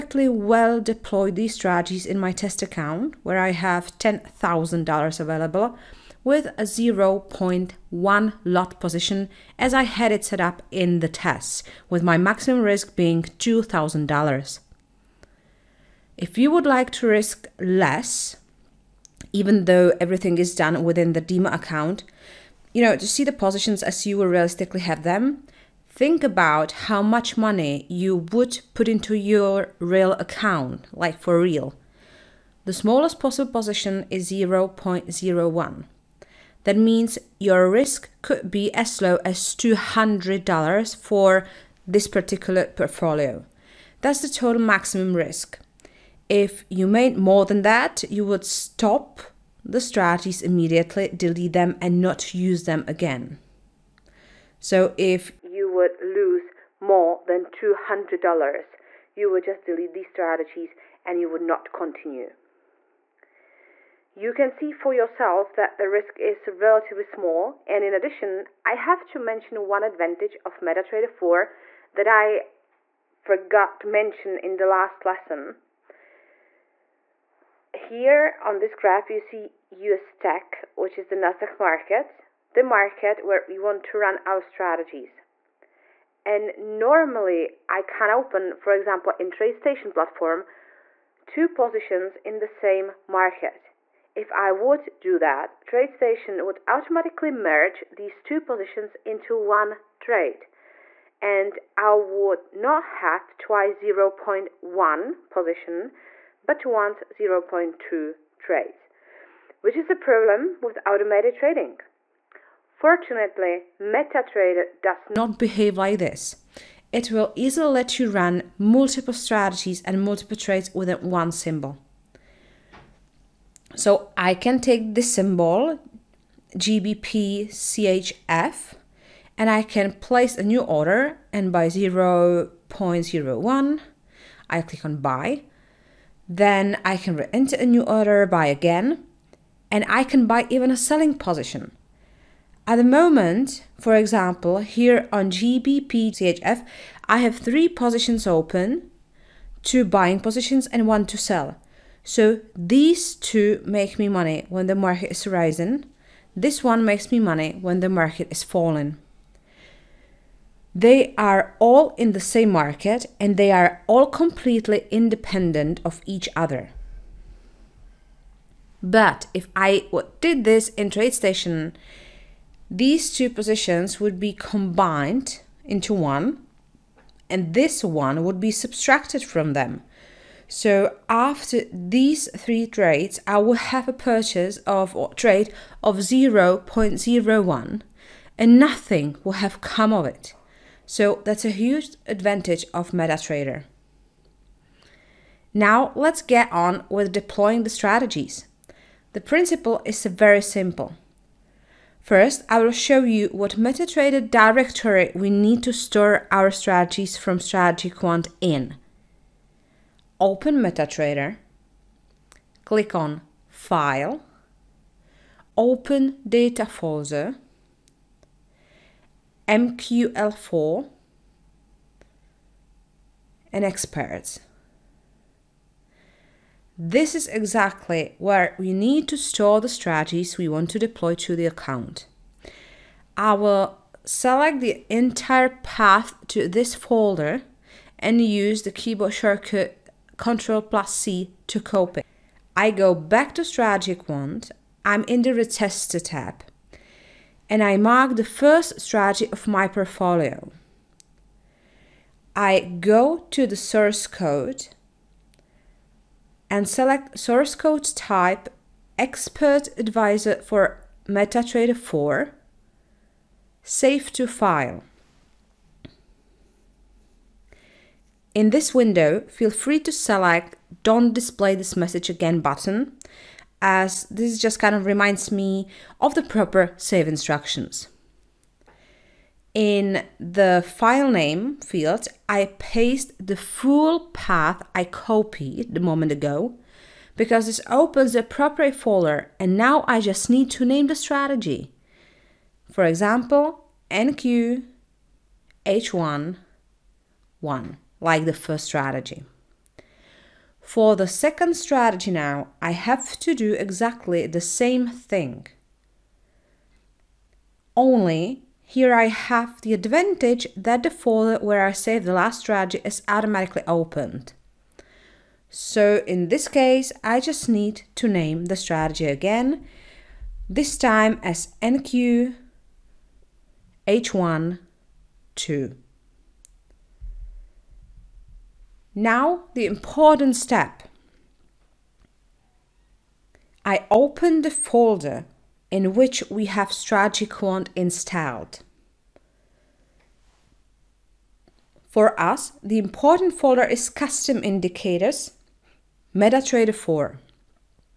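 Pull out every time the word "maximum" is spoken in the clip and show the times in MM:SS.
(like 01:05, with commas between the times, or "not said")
00:12, 00:44.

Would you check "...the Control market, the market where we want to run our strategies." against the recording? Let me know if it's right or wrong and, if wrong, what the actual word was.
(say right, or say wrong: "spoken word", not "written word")
wrong: "NASDAQ", not "Control".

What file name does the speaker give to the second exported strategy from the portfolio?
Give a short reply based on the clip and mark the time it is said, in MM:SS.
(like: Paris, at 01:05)
NQ H1 2, at 05:21.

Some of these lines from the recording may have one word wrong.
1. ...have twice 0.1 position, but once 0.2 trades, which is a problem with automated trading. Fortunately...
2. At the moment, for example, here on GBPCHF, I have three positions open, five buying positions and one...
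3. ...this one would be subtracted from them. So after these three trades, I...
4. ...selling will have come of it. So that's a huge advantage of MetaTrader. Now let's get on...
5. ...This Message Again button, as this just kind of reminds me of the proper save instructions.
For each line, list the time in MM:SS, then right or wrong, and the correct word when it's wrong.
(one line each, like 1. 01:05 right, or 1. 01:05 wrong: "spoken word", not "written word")
1. 01:43 right
2. 02:22 wrong: "two", not "five"
3. 02:57 right
4. 03:08 wrong: "nothing", not "selling"
5. 04:31 right.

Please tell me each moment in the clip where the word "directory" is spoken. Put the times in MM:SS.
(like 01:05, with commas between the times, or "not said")
03:24.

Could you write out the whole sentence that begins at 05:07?
Only here I have the advantage that the folder where I saved the last strategy is automatically opened.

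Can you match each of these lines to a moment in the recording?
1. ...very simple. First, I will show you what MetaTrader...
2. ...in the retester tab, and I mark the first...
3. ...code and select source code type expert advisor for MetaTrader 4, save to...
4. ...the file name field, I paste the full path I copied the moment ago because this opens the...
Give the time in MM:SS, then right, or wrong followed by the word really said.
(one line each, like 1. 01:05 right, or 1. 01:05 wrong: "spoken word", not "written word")
1. 03:20 right
2. 04:05 right
3. 04:14 right
4. 04:40 right.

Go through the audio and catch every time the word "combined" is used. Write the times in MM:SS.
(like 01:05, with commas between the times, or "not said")
02:54.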